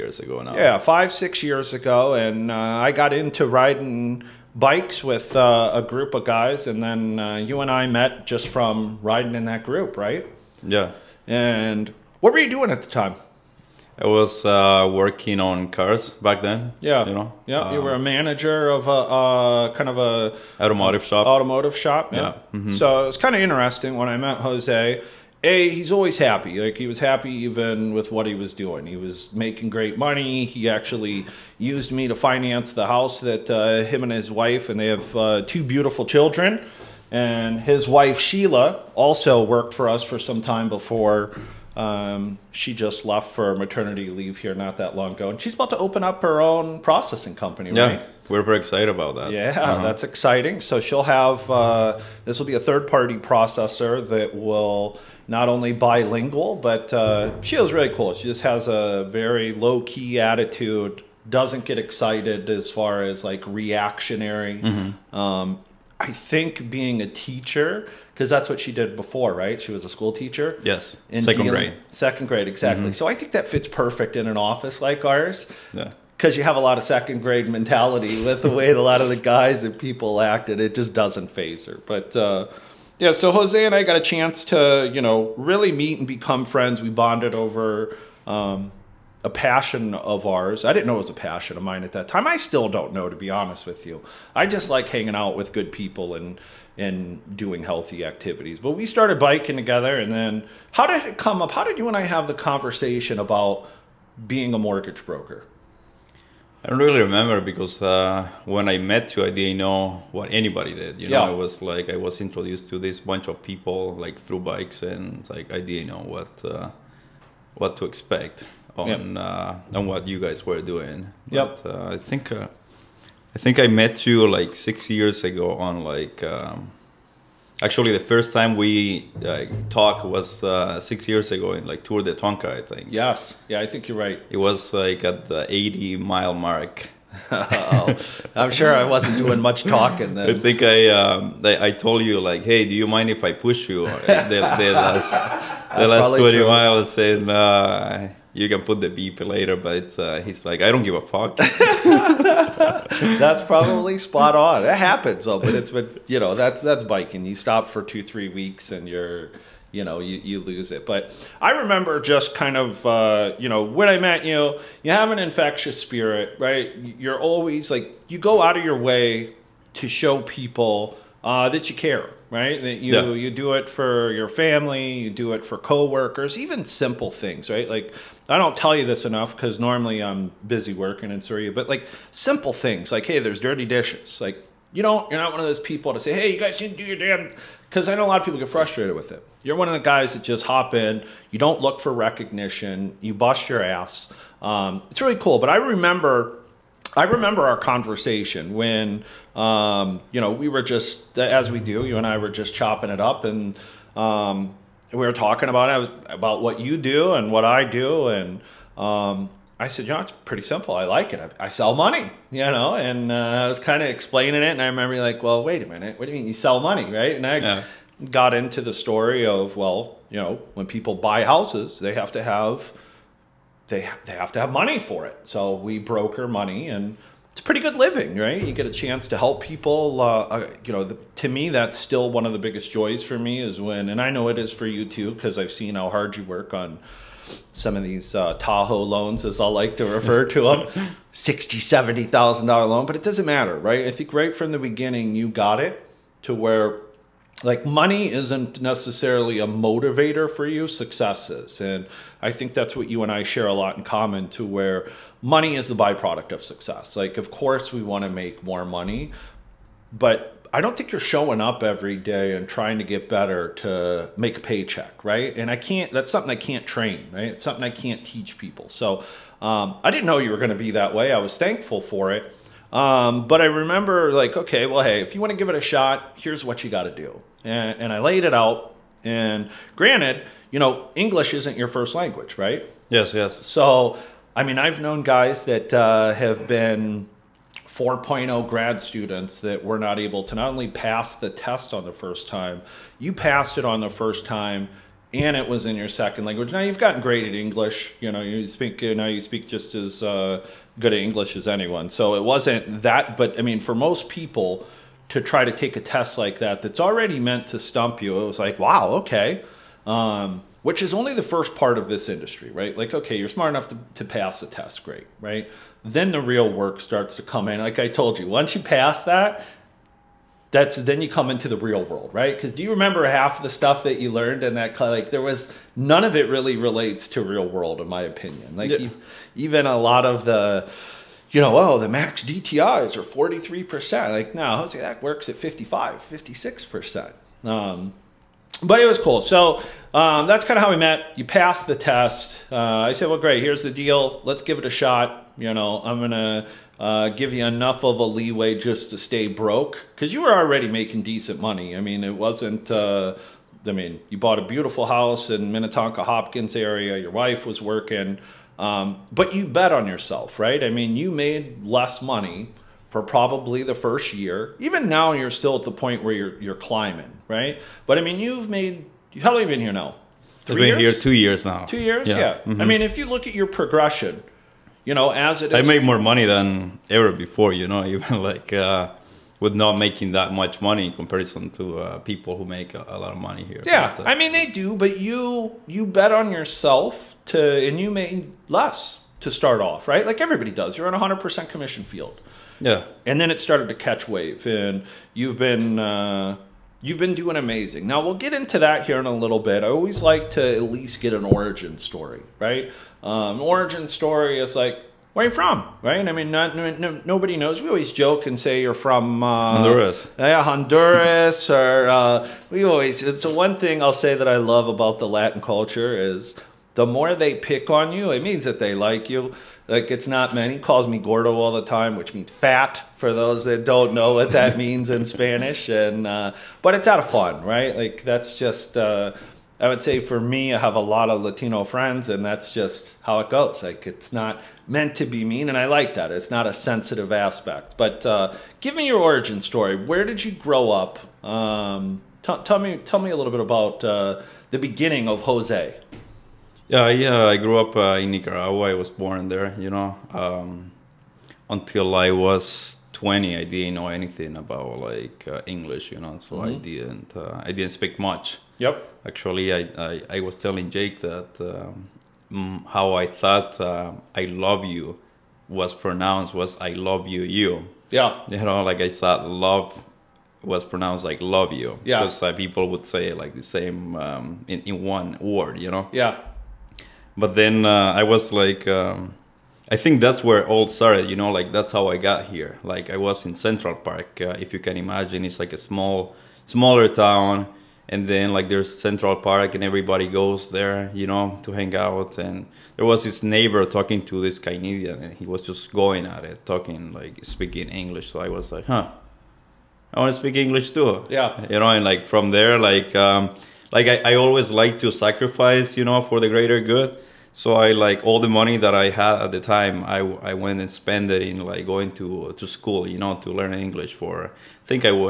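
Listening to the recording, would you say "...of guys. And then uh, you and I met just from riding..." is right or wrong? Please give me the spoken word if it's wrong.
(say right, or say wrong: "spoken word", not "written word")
right.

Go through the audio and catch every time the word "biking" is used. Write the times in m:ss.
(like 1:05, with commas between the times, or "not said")
1:39, 2:36.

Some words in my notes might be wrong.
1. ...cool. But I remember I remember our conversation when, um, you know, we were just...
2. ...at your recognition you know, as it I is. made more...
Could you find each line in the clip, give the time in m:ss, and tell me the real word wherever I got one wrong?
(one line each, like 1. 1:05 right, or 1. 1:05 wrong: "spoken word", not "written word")
1. 3:15 right
2. 6:13 wrong: "progression", not "recognition".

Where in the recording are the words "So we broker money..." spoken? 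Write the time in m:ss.
3:45.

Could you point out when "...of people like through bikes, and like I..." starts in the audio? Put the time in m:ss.
1:53.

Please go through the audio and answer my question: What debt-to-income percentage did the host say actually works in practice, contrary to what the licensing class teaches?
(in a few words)
55 to 56 percent.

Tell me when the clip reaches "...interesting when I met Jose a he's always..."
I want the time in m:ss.
0:23.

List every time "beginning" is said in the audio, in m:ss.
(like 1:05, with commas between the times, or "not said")
4:04, 7:24.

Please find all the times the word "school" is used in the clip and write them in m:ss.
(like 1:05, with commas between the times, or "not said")
1:09, 8:32.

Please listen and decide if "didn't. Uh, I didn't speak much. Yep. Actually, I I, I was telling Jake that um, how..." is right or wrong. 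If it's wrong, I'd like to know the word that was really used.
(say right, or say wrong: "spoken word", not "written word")
right.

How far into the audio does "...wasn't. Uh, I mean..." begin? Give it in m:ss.
5:52.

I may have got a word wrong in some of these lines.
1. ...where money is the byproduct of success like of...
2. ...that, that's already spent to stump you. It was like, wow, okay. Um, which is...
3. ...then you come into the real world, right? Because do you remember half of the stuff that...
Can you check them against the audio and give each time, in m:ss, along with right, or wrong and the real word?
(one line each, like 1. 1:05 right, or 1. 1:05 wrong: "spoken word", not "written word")
1. 4:14 right
2. 5:06 wrong: "meant", not "spent"
3. 5:20 right.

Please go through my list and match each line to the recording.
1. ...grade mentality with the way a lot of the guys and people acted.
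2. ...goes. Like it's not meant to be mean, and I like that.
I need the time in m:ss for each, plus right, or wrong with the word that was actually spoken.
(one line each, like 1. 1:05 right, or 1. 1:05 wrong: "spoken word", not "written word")
1. 1:17 right
2. 7:13 right.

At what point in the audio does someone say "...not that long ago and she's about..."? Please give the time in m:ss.
0:44.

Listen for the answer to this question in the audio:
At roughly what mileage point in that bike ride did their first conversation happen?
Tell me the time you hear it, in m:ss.
2:15.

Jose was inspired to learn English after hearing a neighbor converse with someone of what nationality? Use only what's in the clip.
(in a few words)
Canadian.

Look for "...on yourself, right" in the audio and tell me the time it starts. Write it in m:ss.
5:59.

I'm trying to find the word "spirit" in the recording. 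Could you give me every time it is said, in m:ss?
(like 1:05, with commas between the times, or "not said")
2:45.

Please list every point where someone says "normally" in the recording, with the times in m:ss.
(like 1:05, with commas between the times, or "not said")
2:59.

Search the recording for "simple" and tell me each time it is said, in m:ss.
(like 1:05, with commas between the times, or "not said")
2:56, 3:02, 3:30.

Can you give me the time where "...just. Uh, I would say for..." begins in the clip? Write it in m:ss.
7:08.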